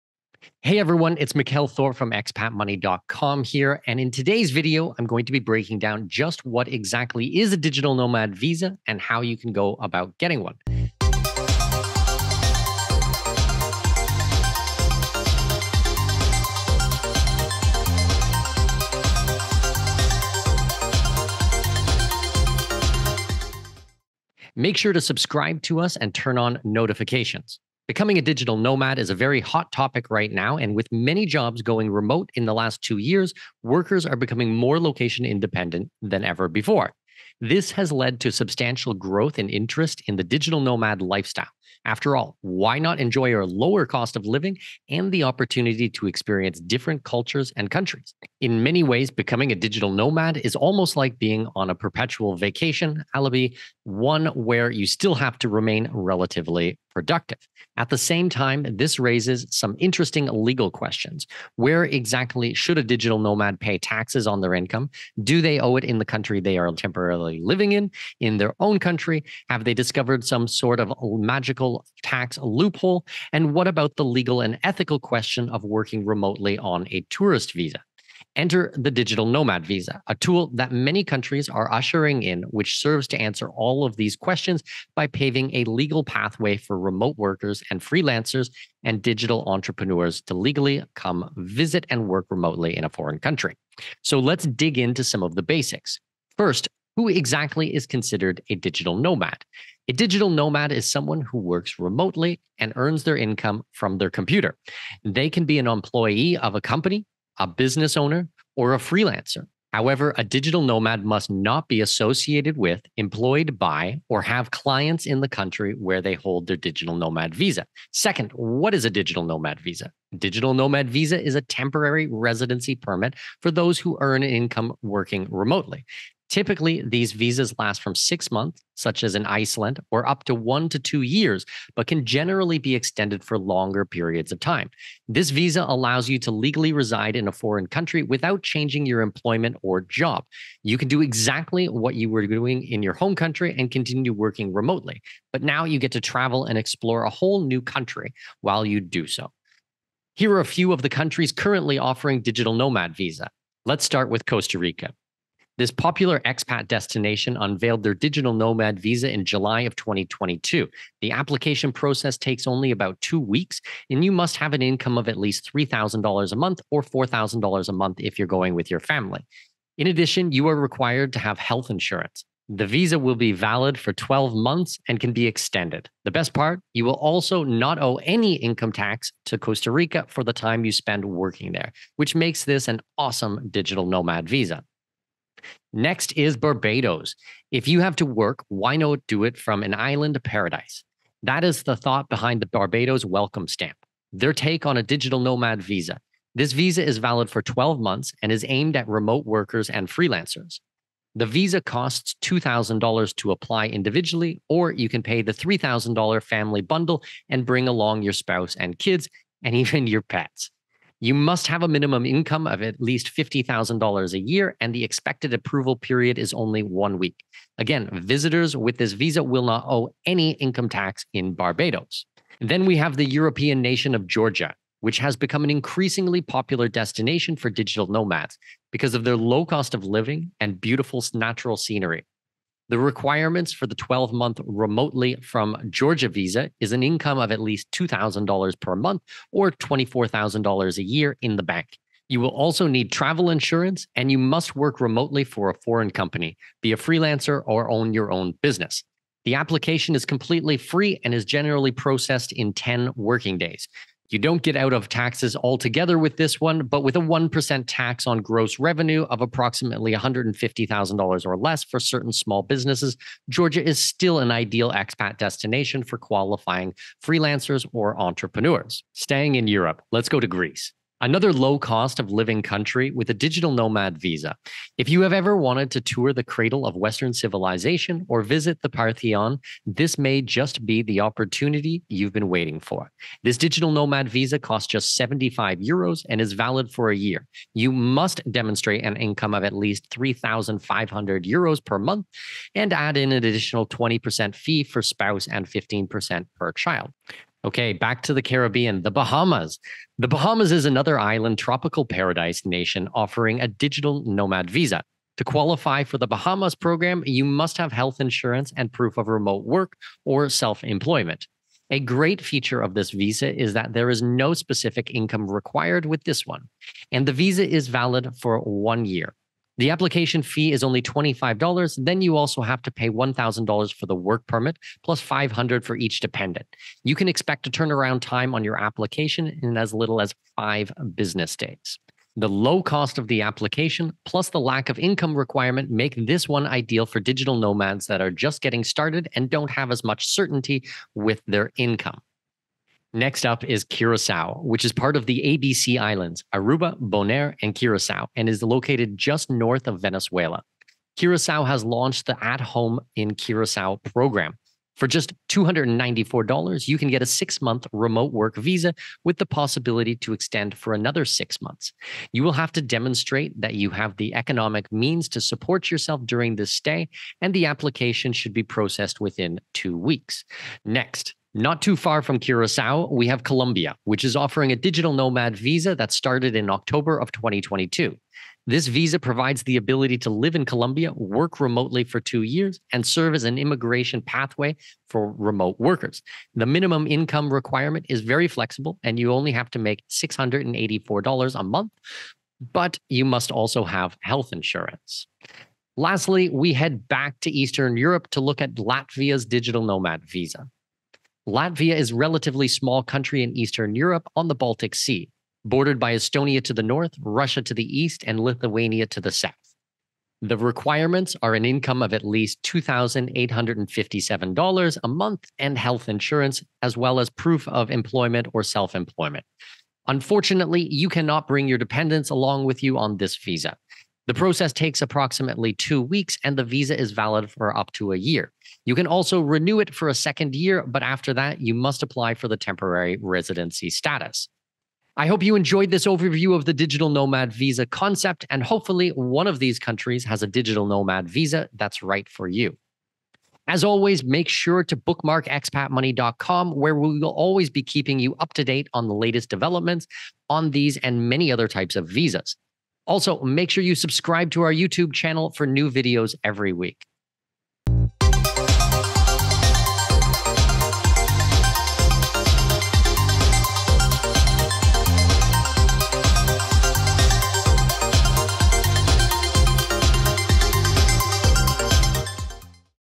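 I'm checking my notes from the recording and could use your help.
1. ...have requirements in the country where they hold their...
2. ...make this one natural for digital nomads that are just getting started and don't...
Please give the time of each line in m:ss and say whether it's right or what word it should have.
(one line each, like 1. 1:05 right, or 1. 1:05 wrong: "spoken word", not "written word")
1. 1:54 wrong: "clients", not "requirements"
2. 5:35 wrong: "ideal", not "natural".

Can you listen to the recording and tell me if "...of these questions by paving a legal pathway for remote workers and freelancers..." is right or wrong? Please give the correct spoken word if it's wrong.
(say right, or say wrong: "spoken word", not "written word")
right.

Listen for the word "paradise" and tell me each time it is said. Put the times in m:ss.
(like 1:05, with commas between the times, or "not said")
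3:10, 5:01.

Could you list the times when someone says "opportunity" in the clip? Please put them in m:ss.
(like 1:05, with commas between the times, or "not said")
0:45, 4:40.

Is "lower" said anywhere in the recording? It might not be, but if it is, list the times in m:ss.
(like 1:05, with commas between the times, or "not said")
0:43.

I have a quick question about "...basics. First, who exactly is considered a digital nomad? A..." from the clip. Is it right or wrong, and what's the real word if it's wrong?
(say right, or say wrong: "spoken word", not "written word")
right.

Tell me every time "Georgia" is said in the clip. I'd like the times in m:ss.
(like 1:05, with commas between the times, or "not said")
3:44, 3:55, 4:23.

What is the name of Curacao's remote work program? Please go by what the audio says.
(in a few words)
At Home in Curacao.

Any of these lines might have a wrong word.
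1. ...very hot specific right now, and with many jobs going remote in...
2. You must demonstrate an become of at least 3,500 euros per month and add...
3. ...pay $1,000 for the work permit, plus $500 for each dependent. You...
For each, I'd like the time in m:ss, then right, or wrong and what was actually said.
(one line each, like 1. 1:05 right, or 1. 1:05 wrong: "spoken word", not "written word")
1. 0:29 wrong: "topic", not "specific"
2. 4:47 wrong: "income", not "become"
3. 5:22 right.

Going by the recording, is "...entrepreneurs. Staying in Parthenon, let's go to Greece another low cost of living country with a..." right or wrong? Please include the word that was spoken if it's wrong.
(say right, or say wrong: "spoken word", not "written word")
wrong: "Europe", not "Parthenon".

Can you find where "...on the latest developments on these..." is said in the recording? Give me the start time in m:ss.
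7:28.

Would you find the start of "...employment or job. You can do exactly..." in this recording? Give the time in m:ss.
2:19.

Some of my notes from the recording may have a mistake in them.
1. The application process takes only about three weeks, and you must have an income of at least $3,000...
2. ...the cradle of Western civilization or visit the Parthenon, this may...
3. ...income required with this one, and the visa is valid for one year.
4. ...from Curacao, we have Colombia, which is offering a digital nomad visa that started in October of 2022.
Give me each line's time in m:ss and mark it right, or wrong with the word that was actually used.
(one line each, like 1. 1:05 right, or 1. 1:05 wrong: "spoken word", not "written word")
1. 2:41 wrong: "two", not "three"
2. 4:36 right
3. 5:14 right
4. 6:12 right.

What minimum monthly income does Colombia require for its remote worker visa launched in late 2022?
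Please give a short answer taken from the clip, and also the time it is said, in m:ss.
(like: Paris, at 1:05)
$684, at 6:29.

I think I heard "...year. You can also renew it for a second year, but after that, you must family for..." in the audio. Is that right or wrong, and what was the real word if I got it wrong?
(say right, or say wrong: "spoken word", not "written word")
wrong: "apply", not "family".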